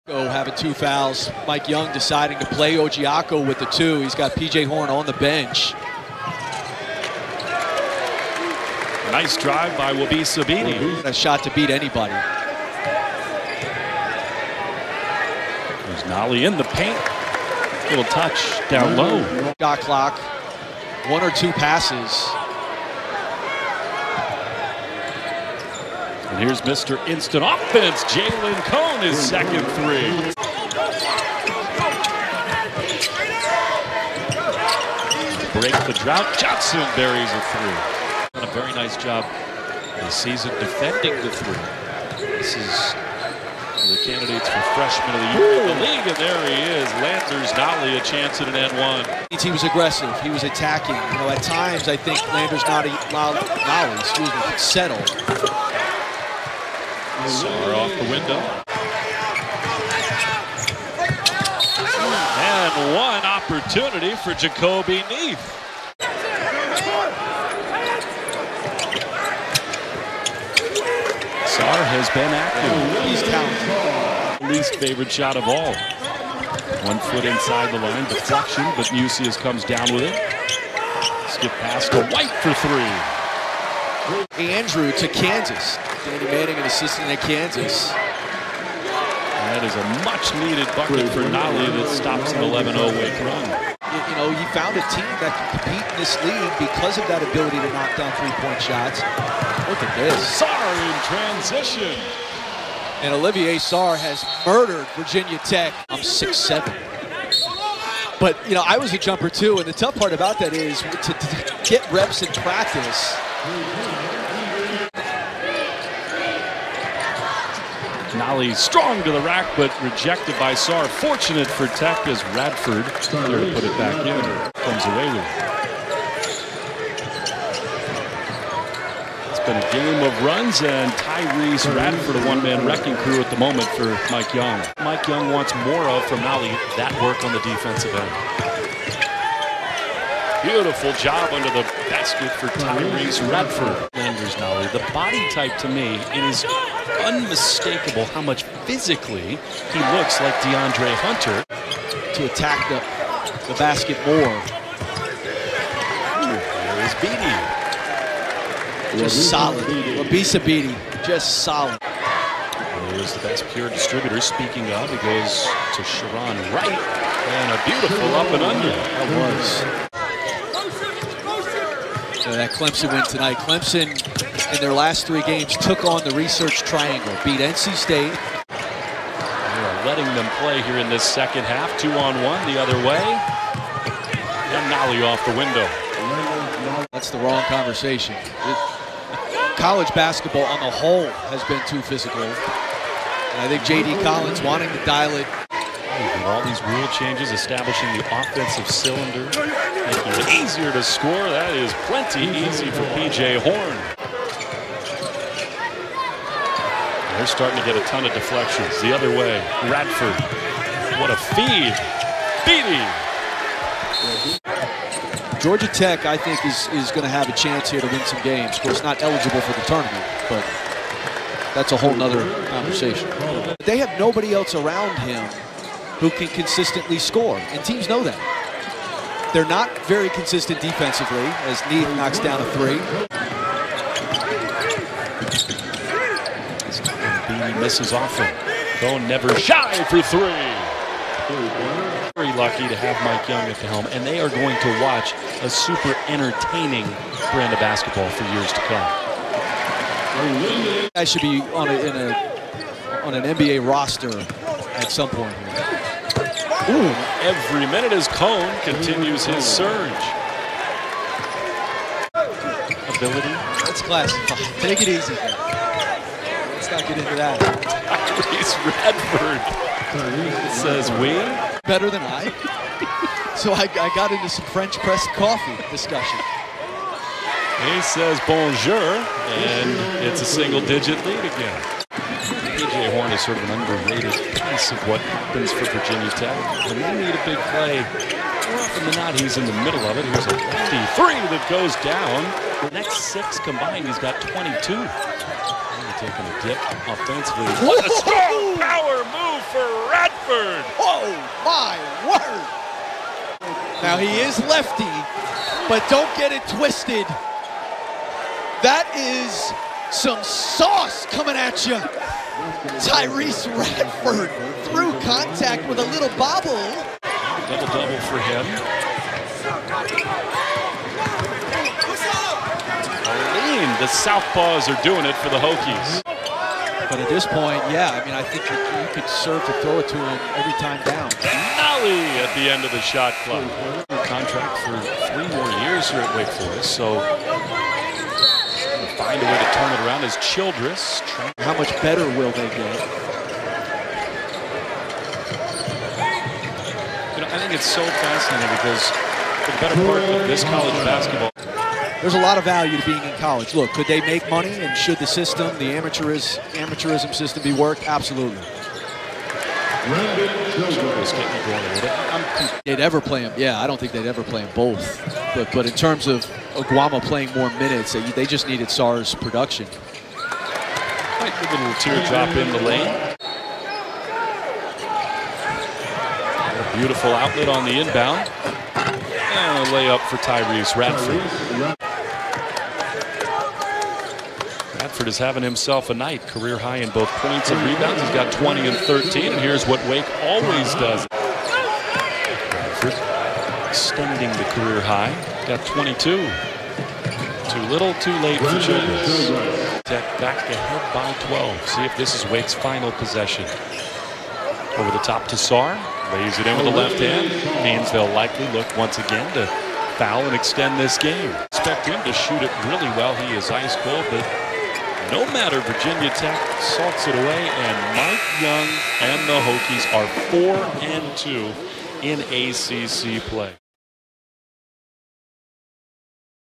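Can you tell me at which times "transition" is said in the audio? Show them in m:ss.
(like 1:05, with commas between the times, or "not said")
1:41.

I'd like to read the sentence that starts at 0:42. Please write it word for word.
This is the candidates for freshman of the year in the league, and there he is.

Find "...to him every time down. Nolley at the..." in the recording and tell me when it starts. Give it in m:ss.
5:29.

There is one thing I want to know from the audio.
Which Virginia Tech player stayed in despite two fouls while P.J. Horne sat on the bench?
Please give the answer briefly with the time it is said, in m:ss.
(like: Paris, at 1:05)
Ojiako, at 0:02.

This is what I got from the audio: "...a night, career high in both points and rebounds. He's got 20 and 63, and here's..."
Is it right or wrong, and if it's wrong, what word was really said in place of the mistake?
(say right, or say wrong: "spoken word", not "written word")
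wrong: "13", not "63".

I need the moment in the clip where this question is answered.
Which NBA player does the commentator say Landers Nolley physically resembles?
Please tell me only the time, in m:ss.
2:30.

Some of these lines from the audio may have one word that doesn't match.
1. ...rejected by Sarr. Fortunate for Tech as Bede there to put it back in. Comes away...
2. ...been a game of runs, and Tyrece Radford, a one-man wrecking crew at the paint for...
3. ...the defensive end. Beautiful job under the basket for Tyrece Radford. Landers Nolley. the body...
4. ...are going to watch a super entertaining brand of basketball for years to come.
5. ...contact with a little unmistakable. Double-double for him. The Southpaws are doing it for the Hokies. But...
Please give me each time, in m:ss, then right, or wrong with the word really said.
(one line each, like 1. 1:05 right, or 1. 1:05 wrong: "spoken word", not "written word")
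1. 1:59 wrong: "Radford", not "Bede"
2. 2:09 wrong: "moment", not "paint"
3. 2:17 right
4. 4:04 right
5. 5:15 wrong: "bobble", not "unmistakable".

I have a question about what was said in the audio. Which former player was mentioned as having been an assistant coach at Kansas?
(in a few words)
Danny Manning.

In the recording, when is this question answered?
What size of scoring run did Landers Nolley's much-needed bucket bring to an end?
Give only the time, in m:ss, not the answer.
1:32.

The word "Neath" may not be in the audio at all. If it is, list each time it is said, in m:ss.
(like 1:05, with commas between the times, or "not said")
1:05, 3:51.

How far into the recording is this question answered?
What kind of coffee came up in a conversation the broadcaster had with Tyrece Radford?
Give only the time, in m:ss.
4:34.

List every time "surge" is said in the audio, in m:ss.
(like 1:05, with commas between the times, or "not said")
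4:19.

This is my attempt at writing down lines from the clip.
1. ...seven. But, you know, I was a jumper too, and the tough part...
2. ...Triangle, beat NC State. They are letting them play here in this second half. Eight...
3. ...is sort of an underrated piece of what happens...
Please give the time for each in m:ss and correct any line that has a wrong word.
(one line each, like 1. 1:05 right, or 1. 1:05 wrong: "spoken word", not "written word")
1. 1:46 right
2. 2:56 wrong: "Two", not "Eight"
3. 4:43 right.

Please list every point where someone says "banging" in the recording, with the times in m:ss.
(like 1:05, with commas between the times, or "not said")
not said.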